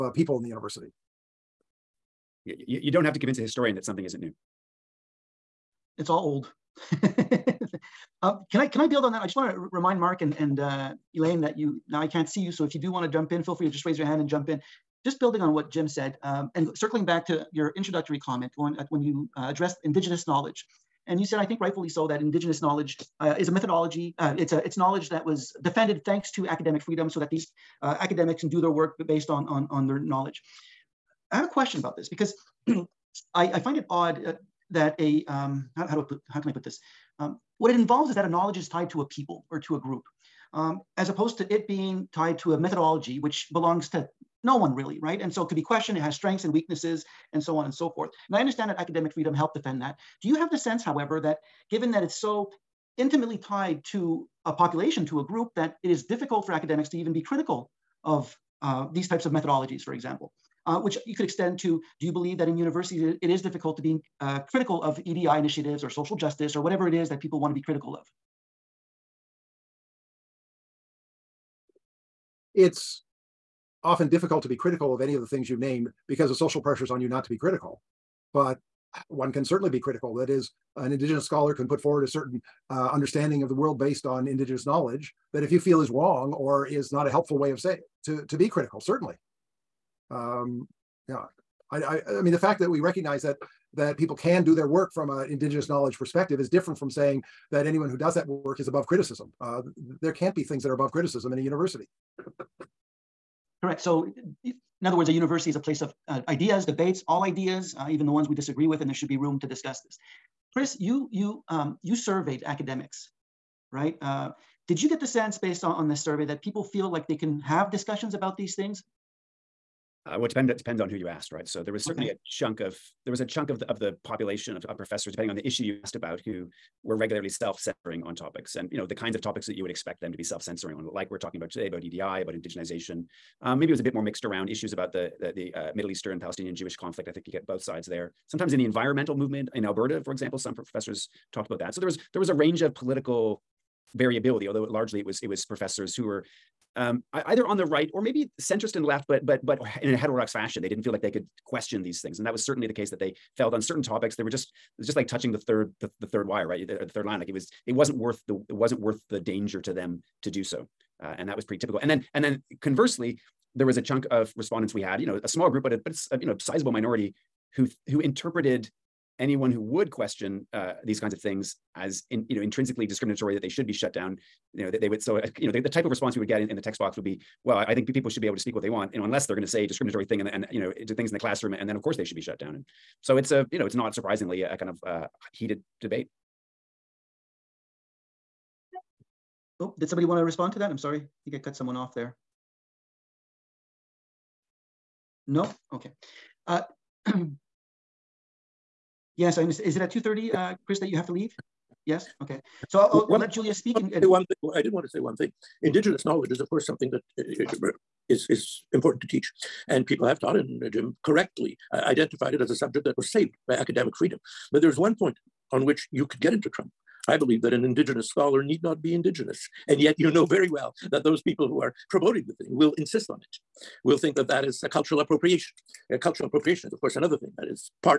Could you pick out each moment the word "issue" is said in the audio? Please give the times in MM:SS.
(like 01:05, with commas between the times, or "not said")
02:05, 02:14.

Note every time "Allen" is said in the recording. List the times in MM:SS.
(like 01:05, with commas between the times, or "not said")
not said.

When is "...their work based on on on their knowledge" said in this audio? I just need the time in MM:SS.
00:28.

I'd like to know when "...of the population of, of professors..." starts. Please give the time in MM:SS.
02:03.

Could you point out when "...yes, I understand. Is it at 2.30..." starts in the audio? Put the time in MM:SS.
03:19.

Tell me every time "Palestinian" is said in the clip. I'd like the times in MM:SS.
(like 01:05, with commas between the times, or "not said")
02:16.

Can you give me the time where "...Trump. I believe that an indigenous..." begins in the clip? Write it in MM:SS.
03:36.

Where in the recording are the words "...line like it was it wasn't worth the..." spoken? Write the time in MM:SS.
02:37.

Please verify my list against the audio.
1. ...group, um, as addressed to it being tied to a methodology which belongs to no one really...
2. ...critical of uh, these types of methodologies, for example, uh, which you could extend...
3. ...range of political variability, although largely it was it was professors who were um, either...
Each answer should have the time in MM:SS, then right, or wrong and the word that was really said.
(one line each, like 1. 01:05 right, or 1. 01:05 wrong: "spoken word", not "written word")
1. 00:39 wrong: "opposed", not "addressed"
2. 00:57 right
3. 02:22 right.